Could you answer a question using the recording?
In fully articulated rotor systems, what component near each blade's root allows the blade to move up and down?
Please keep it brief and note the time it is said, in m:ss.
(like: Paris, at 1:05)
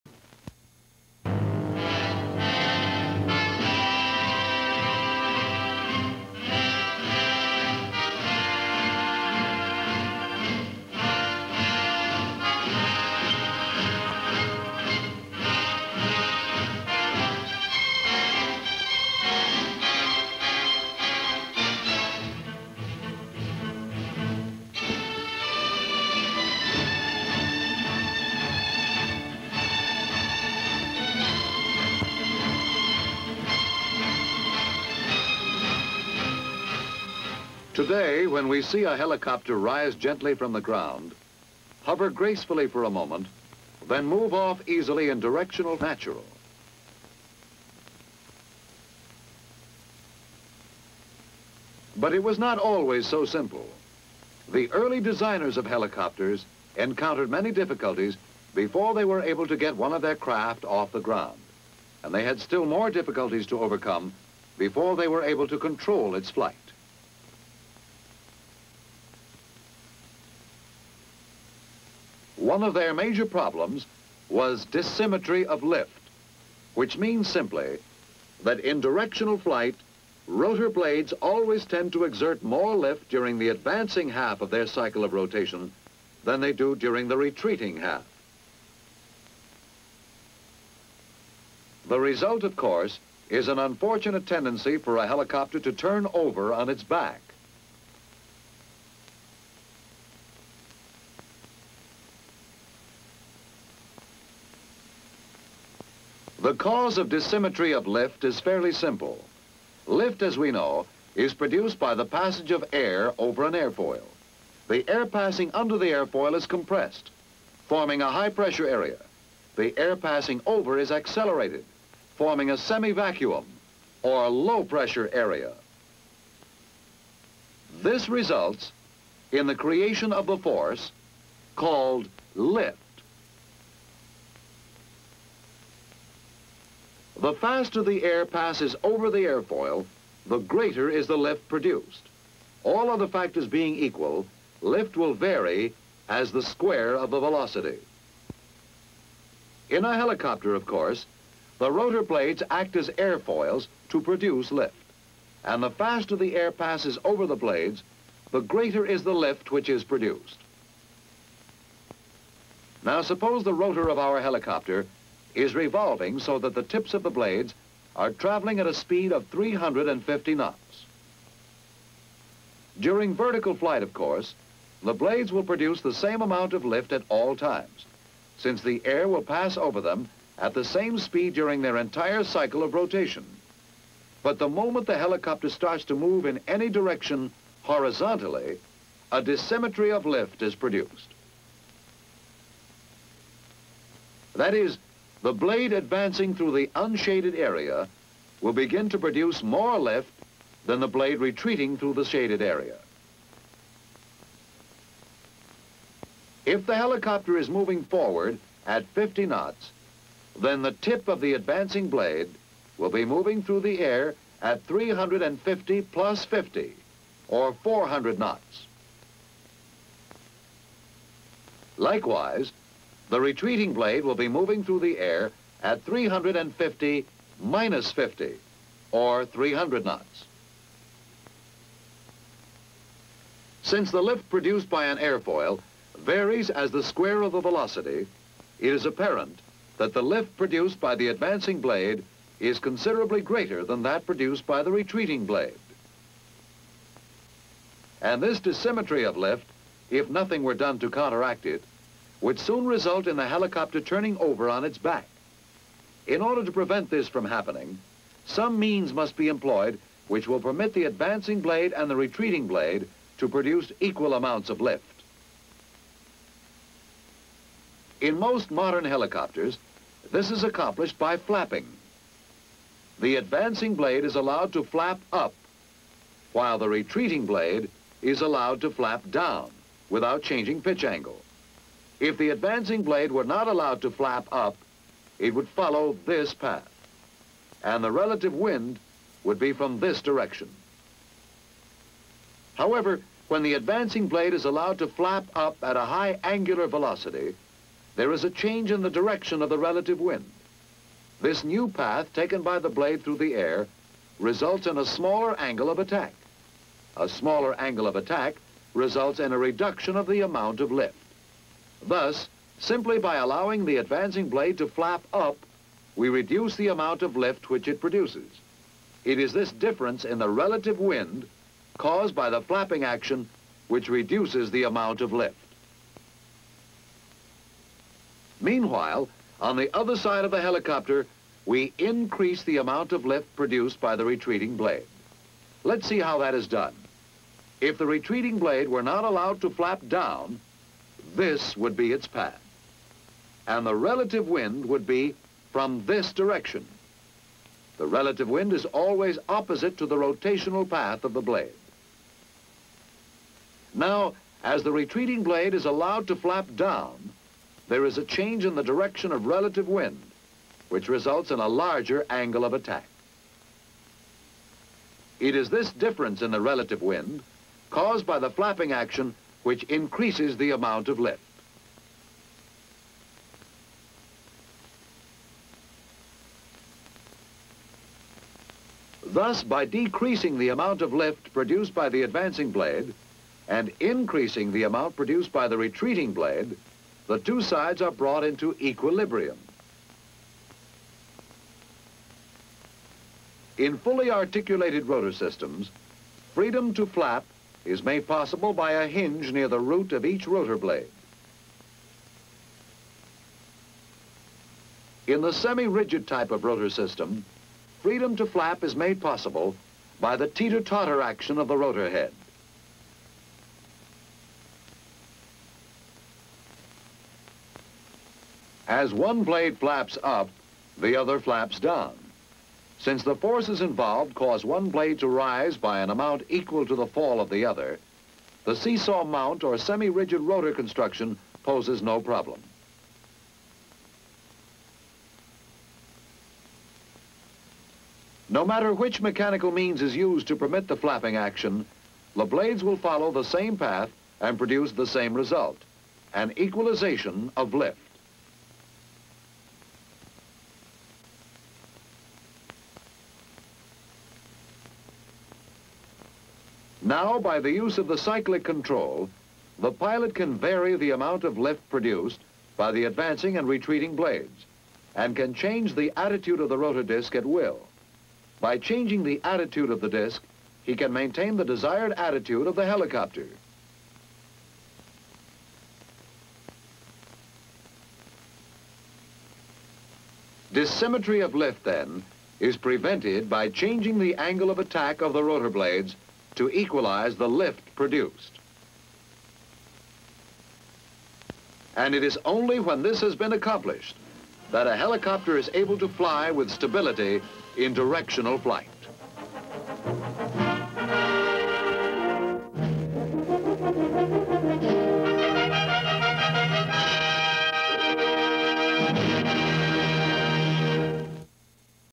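a hinge, at 6:38.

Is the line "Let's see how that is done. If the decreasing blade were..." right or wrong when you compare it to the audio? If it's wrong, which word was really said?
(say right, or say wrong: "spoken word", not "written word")
wrong: "retreating", not "decreasing".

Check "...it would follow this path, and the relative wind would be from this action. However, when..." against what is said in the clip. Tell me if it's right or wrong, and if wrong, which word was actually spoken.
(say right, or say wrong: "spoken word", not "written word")
wrong: "direction", not "action".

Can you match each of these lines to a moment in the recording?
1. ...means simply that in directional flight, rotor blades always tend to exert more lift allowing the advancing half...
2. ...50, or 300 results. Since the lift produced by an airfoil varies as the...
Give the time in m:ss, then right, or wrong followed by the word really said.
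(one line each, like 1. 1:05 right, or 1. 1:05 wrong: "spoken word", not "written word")
1. 1:16 wrong: "during", not "allowing"
2. 3:47 wrong: "knots", not "results".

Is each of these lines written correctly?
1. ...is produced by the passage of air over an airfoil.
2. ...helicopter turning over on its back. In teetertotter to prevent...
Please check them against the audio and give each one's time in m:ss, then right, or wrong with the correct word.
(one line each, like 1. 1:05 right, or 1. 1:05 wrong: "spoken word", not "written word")
1. 1:51 right
2. 4:13 wrong: "order", not "teetertotter".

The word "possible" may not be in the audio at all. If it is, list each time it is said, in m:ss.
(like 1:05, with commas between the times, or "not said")
6:38, 6:49.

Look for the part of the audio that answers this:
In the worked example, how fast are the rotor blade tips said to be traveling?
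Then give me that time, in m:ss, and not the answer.
2:49.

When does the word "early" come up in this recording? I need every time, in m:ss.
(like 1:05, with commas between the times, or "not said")
0:54.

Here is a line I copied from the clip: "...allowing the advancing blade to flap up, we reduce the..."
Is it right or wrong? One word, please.
right.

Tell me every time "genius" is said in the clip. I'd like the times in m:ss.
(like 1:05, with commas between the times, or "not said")
not said.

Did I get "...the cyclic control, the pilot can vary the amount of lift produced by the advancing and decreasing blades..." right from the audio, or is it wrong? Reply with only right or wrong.
wrong.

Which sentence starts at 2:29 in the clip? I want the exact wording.
In a helicopter, of course, the rotor blades act as airfoils to produce lift.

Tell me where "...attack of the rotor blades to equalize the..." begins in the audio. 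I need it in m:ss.
8:04.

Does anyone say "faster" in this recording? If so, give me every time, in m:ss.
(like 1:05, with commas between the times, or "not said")
2:17, 2:35.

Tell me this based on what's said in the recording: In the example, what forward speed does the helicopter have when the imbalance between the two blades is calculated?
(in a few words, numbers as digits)
50 knots.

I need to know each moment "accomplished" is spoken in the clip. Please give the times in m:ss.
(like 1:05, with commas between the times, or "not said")
4:30, 8:13.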